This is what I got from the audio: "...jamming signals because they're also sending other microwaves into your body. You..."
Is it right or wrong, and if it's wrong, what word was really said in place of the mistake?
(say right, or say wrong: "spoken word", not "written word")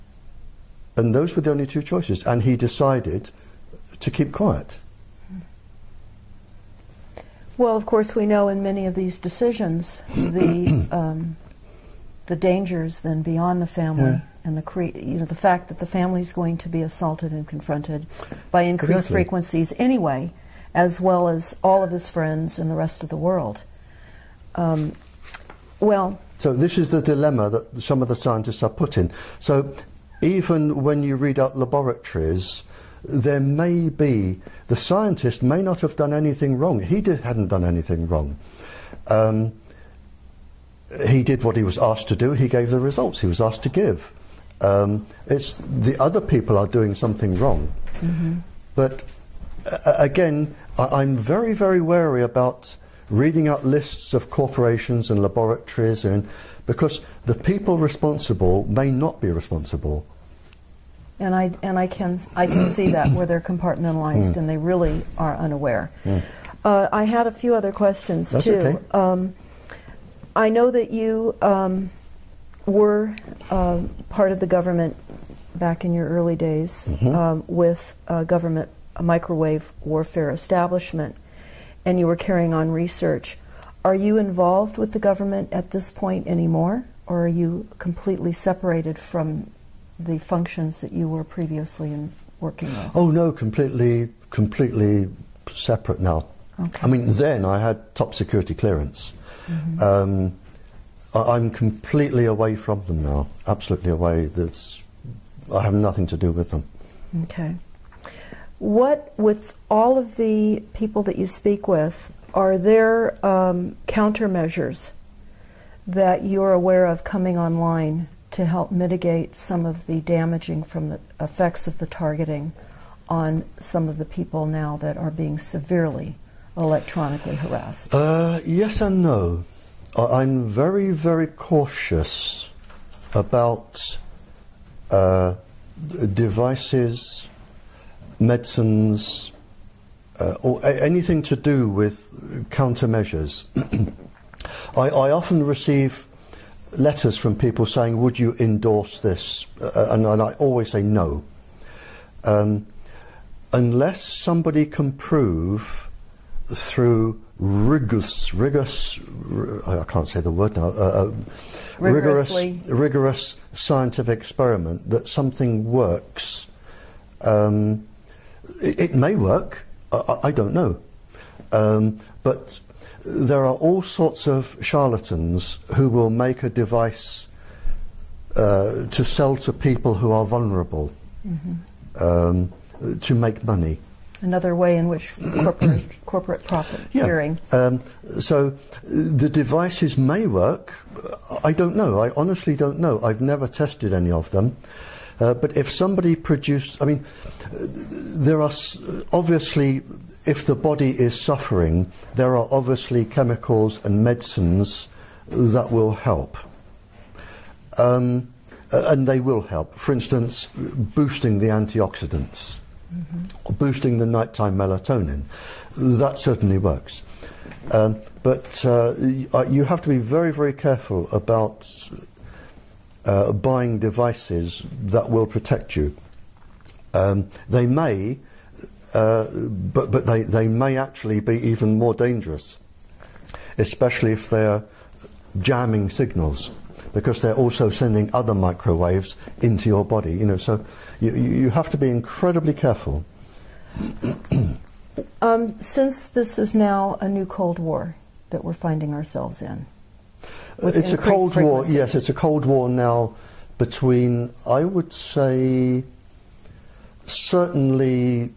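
right.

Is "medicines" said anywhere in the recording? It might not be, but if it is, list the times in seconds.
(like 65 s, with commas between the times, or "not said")
138 s, 204 s.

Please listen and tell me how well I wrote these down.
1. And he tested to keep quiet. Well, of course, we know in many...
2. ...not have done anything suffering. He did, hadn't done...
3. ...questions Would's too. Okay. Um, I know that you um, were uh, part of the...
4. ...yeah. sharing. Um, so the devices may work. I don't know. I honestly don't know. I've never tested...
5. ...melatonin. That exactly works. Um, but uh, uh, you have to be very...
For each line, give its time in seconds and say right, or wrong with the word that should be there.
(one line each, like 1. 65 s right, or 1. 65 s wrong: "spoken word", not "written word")
1. 2 s wrong: "decided", not "tested"
2. 35 s wrong: "wrong", not "suffering"
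3. 67 s wrong: "That", not "Would"
4. 186 s right
5. 214 s wrong: "certainly", not "exactly".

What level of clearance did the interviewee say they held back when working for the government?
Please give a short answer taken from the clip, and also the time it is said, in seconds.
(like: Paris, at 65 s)
Top security clearance, at 97 s.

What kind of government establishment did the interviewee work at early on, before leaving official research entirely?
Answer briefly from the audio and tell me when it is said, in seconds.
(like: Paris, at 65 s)
Microwave warfare establishment, at 79 s.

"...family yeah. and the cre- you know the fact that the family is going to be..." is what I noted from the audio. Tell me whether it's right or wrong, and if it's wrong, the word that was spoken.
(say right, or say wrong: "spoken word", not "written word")
right.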